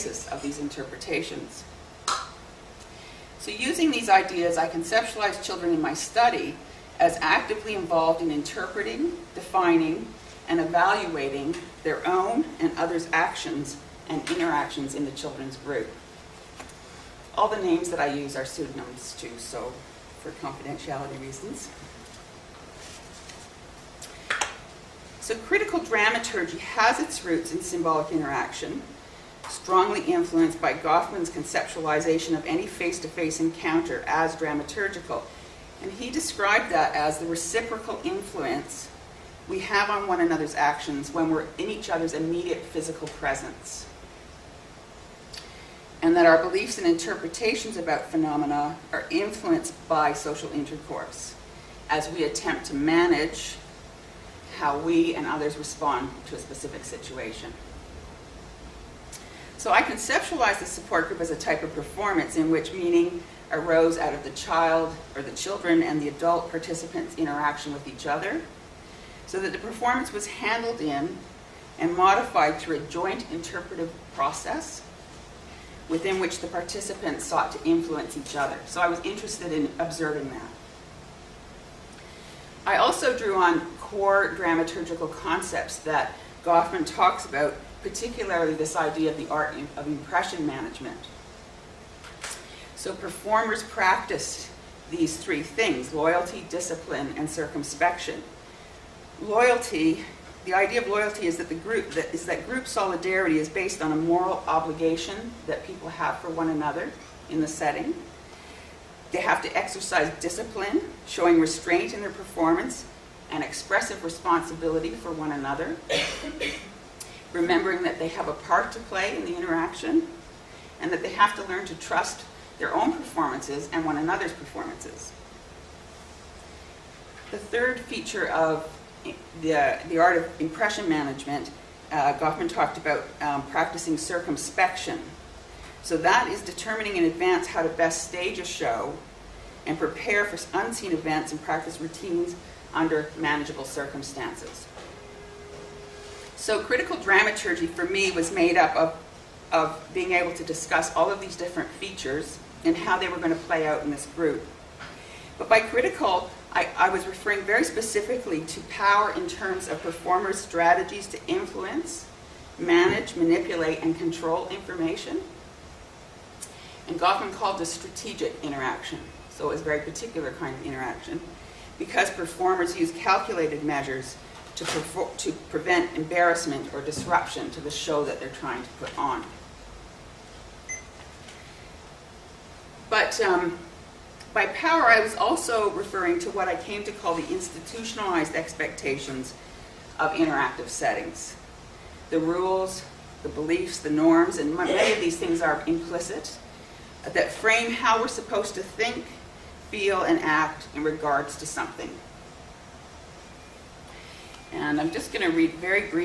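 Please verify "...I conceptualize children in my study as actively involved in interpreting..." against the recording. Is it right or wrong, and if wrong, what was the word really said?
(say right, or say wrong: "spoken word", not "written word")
right.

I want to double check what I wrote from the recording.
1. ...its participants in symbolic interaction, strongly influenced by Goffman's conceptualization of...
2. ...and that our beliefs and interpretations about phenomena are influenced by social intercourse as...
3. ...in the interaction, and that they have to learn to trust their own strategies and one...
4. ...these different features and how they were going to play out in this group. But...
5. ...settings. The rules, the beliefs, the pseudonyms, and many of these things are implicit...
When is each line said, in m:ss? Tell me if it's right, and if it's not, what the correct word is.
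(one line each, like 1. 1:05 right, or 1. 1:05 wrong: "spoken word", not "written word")
1. 0:26 wrong: "roots", not "participants"
2. 0:46 right
3. 1:59 wrong: "performances", not "strategies"
4. 2:31 right
5. 3:10 wrong: "norms", not "pseudonyms".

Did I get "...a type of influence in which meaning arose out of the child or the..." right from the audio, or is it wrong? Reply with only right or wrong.
wrong.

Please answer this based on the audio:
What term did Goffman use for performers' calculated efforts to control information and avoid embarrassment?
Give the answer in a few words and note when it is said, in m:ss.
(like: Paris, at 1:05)
Strategic interaction, at 2:47.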